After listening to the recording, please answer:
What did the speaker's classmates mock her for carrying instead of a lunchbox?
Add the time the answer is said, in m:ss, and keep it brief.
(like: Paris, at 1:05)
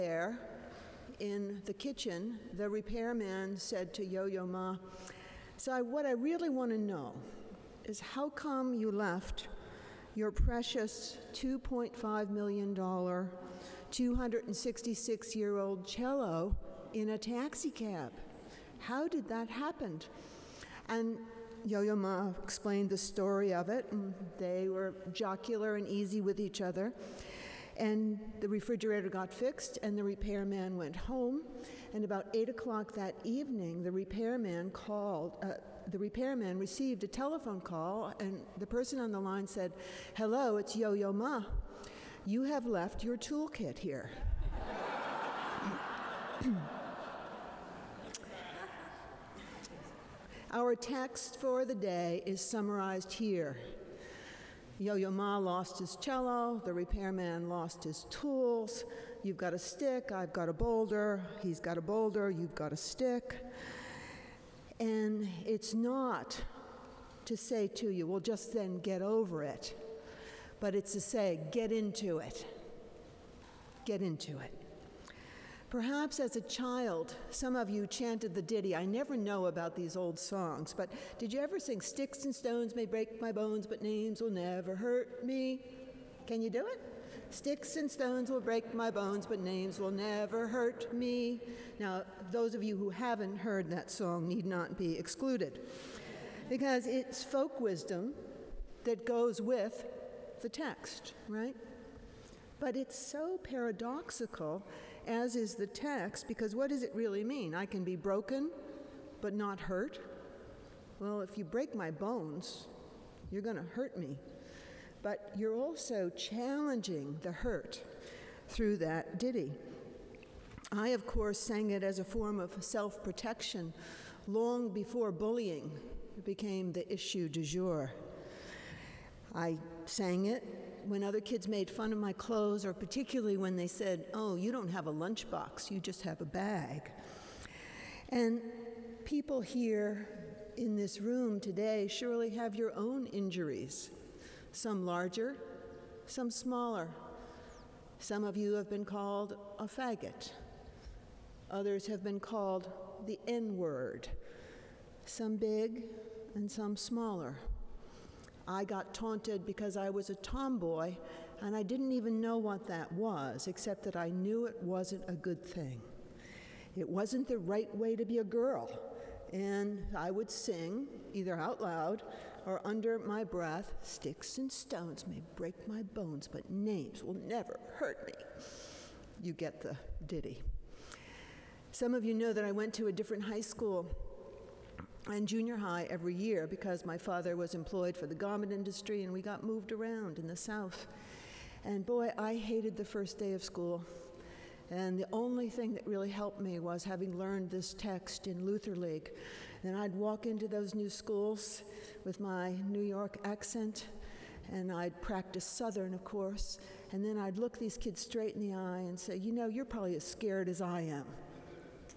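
a bag, at 2:16.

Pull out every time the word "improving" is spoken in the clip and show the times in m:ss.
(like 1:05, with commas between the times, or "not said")
not said.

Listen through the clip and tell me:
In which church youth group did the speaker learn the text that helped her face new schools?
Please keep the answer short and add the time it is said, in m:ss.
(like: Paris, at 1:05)
Luther League, at 3:18.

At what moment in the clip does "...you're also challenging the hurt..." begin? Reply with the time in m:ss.
1:55.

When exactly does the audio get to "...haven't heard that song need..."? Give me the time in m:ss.
1:32.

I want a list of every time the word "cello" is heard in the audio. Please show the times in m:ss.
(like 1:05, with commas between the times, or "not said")
0:15, 0:55.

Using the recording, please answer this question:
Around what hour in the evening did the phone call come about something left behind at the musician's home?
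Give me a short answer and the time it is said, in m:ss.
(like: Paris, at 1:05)
8 o'clock, at 0:32.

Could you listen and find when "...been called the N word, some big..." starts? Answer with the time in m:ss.
2:32.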